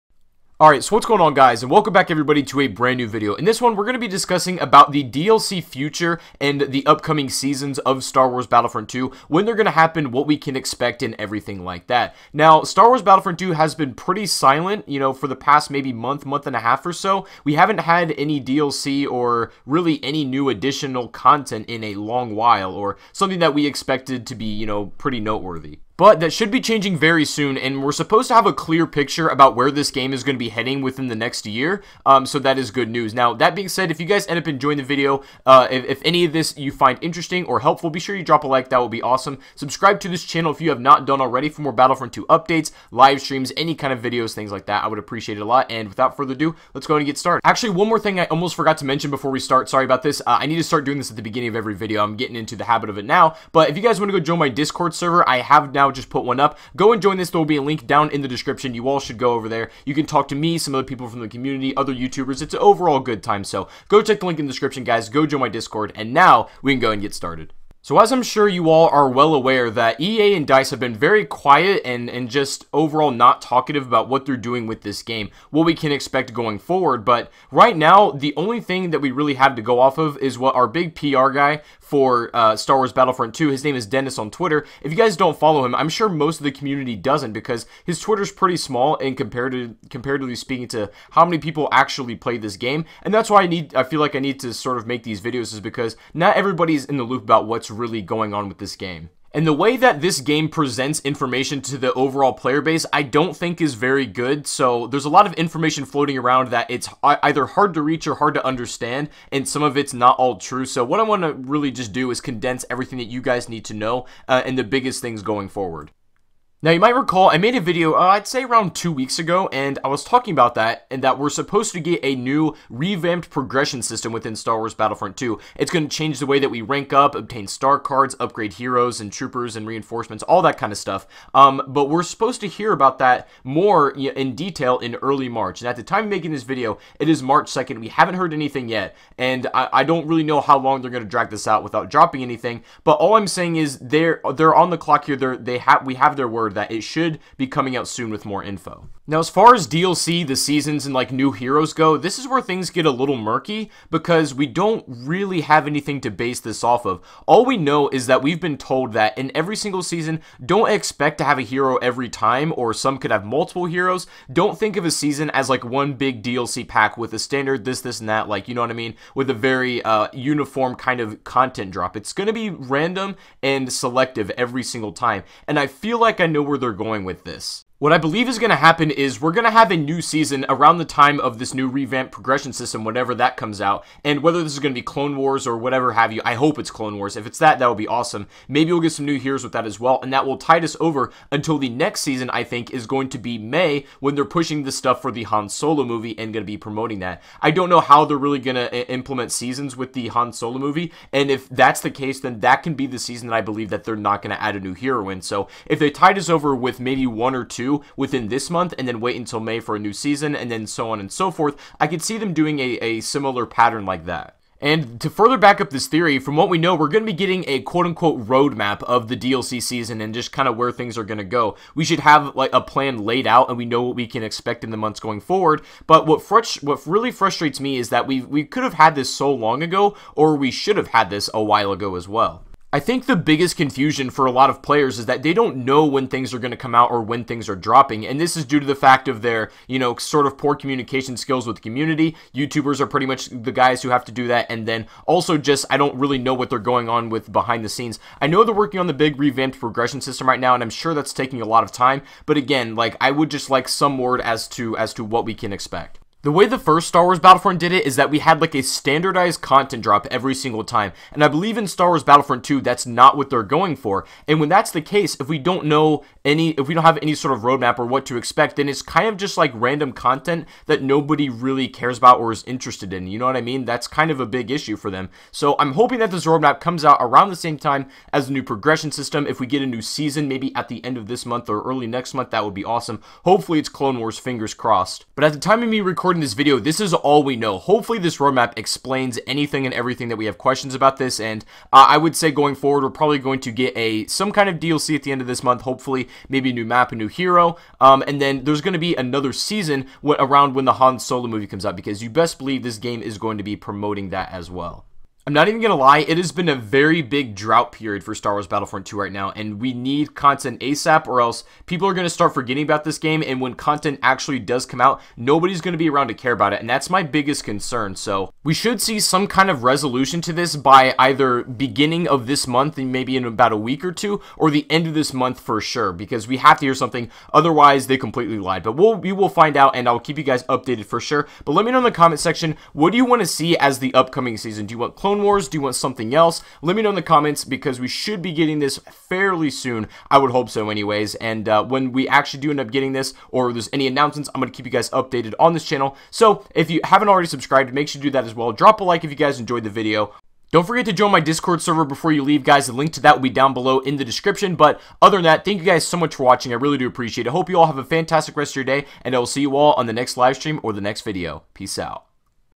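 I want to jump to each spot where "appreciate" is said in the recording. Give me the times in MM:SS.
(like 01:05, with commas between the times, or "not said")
00:44, 05:56.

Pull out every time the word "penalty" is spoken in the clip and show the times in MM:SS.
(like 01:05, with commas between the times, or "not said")
not said.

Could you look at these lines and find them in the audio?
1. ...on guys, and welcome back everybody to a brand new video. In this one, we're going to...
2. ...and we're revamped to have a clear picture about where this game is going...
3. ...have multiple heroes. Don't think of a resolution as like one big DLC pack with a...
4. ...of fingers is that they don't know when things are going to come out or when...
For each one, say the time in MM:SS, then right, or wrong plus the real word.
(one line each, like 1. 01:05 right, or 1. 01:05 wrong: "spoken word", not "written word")
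1. 00:01 right
2. 00:27 wrong: "supposed", not "revamped"
3. 02:43 wrong: "season", not "resolution"
4. 03:54 wrong: "players", not "fingers".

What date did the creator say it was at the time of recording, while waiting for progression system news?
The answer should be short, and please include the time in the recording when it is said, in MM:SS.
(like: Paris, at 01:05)
March 2nd, at 02:17.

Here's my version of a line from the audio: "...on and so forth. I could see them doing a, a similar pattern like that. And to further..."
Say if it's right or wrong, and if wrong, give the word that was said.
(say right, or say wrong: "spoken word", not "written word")
right.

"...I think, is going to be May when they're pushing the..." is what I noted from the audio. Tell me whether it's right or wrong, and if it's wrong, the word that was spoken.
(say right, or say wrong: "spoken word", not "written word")
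right.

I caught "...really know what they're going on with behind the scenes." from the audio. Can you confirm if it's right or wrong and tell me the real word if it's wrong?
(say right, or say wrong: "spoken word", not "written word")
right.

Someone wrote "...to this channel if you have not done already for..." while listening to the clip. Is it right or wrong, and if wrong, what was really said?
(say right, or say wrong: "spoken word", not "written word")
right.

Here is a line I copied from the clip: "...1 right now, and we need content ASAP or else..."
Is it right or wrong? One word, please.
wrong.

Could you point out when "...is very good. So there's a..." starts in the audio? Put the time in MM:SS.
01:43.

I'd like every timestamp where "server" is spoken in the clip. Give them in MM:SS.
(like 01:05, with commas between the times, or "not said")
00:54, 05:51.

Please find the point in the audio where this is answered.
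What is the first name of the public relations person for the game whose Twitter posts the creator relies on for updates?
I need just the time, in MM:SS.
01:23.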